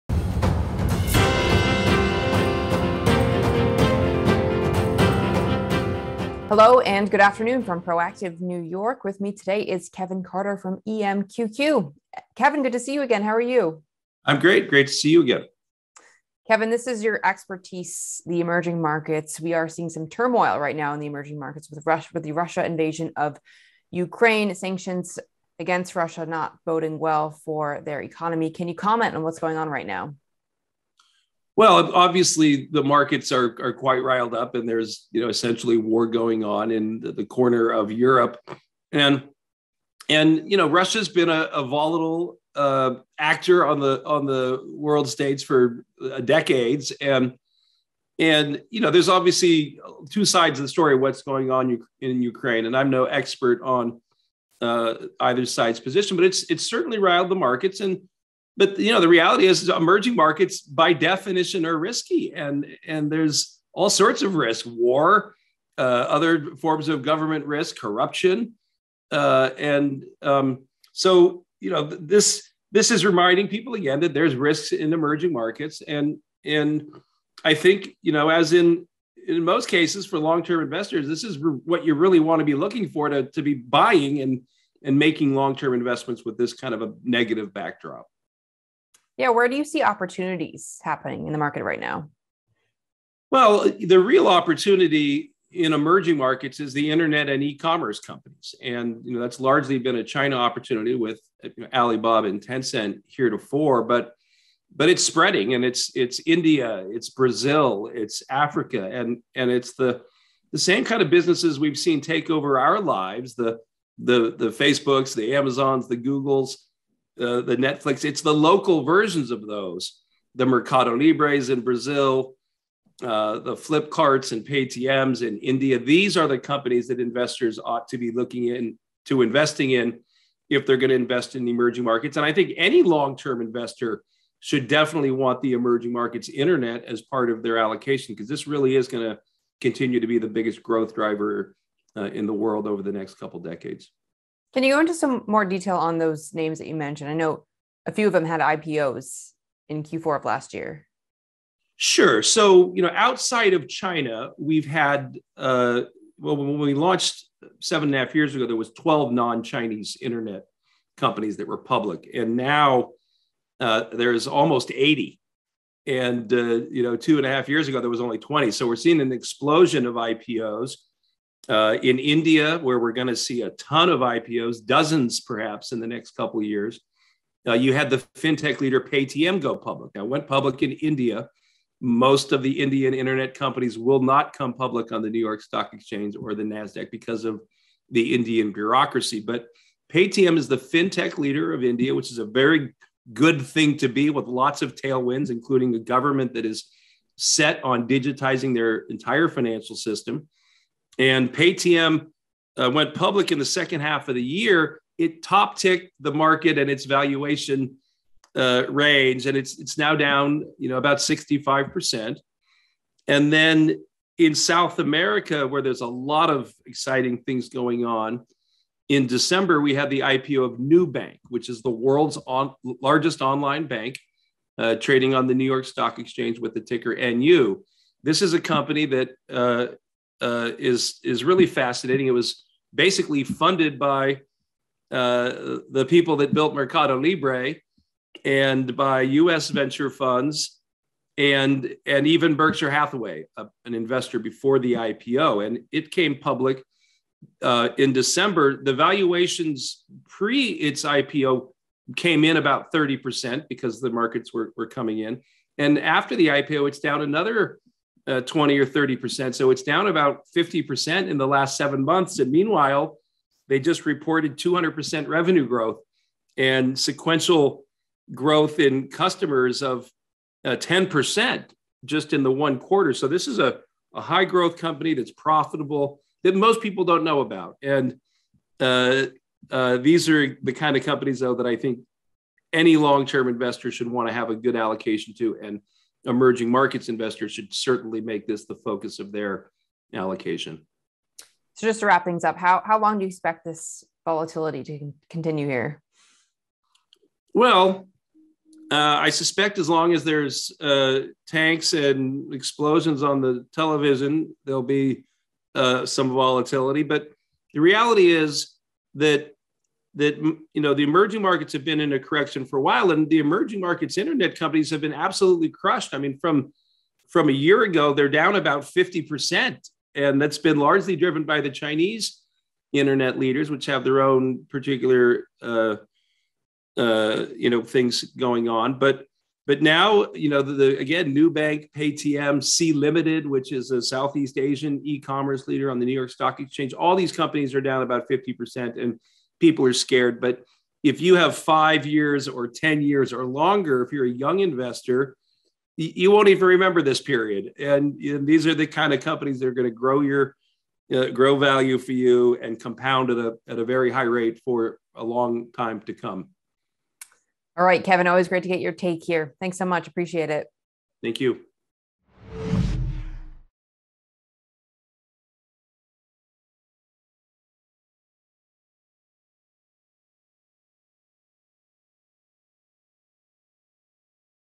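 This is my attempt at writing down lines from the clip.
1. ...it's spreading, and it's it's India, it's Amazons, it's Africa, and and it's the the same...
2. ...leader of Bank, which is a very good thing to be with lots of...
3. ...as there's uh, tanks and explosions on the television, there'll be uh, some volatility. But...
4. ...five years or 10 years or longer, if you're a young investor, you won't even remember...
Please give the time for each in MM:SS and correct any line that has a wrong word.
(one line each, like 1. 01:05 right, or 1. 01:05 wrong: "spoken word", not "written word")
1. 01:44 wrong: "Brazil", not "Amazons"
2. 03:11 wrong: "India", not "Bank"
3. 04:59 right
4. 05:41 right.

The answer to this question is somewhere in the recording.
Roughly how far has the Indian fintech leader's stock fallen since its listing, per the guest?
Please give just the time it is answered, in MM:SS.
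03:31.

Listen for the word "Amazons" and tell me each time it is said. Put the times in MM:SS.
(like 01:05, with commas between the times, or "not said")
01:55.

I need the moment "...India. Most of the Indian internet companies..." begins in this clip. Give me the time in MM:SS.
03:00.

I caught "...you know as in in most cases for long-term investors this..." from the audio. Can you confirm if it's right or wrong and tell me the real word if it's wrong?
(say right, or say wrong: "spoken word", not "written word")
right.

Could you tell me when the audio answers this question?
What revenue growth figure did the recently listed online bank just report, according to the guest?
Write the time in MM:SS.
04:24.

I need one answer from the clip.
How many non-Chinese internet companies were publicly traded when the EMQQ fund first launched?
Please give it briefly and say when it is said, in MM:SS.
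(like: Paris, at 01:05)
12, at 02:38.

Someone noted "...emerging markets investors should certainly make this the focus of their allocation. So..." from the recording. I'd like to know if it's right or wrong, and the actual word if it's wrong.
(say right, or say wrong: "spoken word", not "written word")
right.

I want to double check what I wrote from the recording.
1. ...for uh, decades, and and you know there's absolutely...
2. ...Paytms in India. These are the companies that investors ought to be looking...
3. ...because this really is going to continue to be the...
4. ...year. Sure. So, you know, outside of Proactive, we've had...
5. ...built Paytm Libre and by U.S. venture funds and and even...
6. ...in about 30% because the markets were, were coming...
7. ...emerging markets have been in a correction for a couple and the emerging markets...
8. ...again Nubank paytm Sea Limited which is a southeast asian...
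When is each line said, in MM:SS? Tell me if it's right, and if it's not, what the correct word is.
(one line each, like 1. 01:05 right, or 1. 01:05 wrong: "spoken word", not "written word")
1. 00:45 wrong: "obviously", not "absolutely"
2. 02:04 right
3. 02:18 right
4. 02:30 wrong: "China", not "Proactive"
5. 03:56 wrong: "Mercado", not "Paytm"
6. 04:12 right
7. 05:10 wrong: "while", not "couple"
8. 05:30 right.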